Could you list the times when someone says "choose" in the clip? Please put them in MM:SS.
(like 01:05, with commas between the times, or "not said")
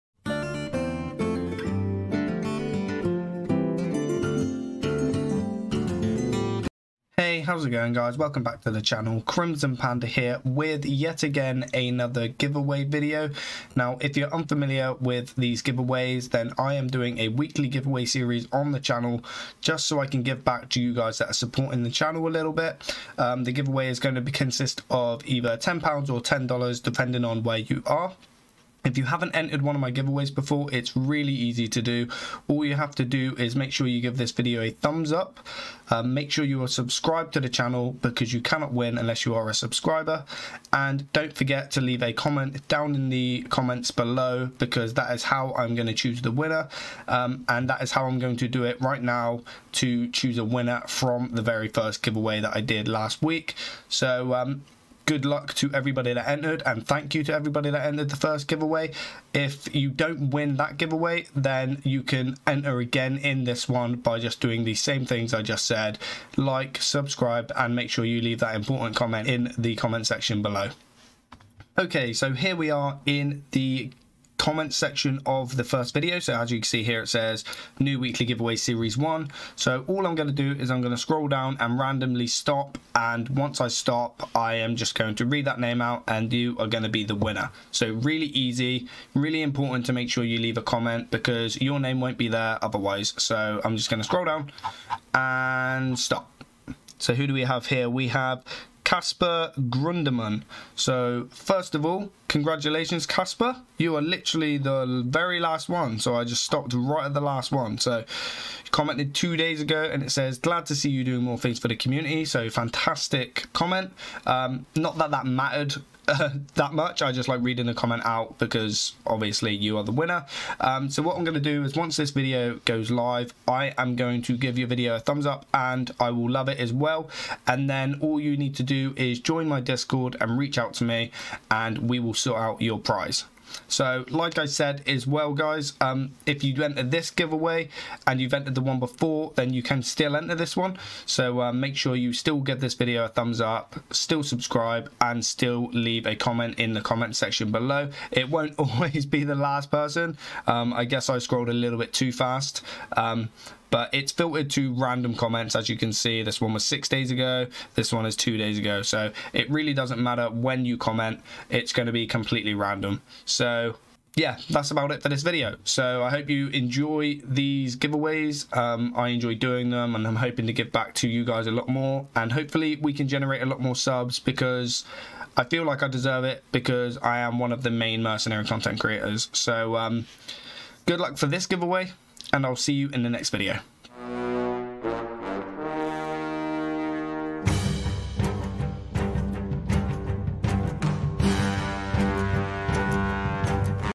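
00:45, 00:50.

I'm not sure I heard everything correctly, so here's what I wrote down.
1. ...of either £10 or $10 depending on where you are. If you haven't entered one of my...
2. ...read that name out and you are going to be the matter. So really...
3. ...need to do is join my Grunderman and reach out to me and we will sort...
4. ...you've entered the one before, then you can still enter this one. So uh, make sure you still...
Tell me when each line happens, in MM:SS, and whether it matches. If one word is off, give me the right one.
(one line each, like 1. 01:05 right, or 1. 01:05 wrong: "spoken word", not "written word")
1. 00:24 right
2. 01:25 wrong: "winner", not "matter"
3. 02:08 wrong: "Discord", not "Grunderman"
4. 02:18 right.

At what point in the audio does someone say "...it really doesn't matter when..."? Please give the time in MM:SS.
02:39.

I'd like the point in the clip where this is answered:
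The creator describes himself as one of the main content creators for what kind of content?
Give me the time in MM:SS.
02:58.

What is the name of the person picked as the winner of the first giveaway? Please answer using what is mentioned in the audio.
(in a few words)
Casper Grunderman.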